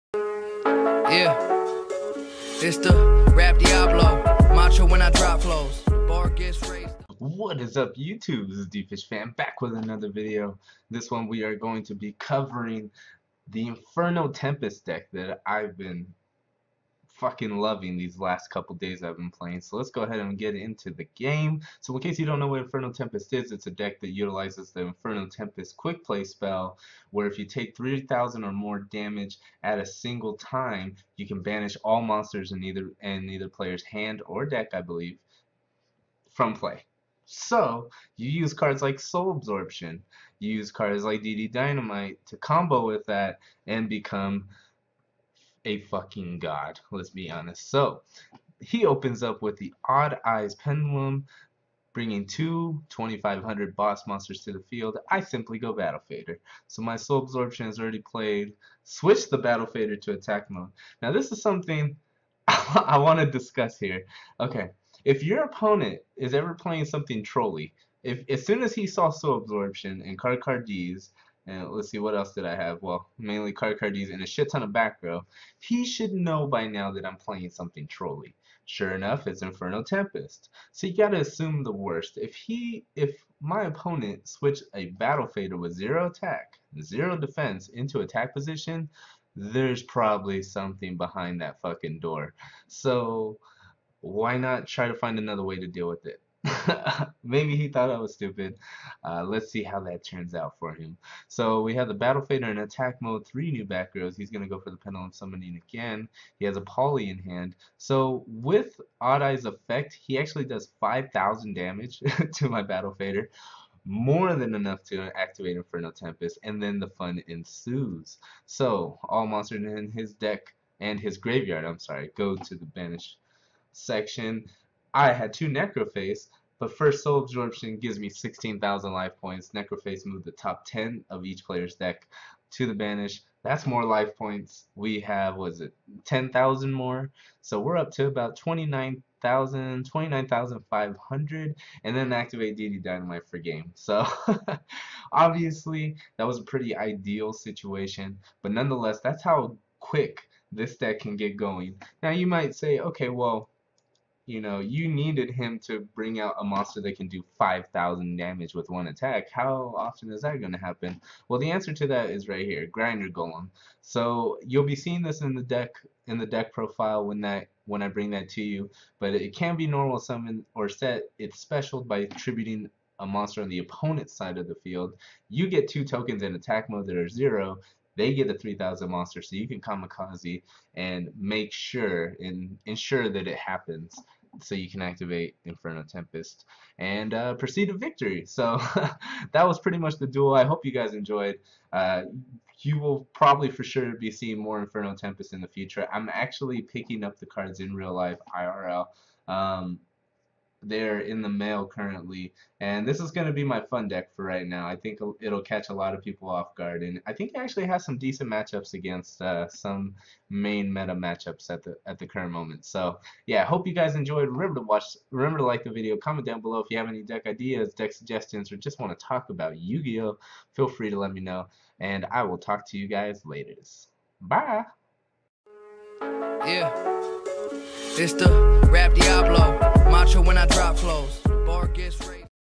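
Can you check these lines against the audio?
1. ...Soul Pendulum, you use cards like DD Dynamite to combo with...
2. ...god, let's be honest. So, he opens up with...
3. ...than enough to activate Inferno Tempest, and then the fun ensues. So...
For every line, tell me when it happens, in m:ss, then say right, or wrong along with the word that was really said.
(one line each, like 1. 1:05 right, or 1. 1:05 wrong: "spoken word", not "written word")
1. 0:38 wrong: "Absorption", not "Pendulum"
2. 0:46 right
3. 1:54 right.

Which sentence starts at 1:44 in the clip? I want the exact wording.
He's going to go for the Pendulum Summoning again.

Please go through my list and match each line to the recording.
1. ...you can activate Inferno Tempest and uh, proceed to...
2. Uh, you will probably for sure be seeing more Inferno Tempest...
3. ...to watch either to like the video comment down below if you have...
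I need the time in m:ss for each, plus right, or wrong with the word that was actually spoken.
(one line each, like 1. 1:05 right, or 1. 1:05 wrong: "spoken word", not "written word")
1. 3:04 right
2. 3:11 right
3. 3:34 wrong: "remember", not "either".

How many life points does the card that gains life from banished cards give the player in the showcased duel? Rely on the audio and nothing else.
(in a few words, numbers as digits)
16,000.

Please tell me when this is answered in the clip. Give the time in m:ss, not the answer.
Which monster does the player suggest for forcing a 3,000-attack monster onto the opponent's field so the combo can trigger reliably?
2:42.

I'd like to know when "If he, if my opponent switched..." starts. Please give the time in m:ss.
1:22.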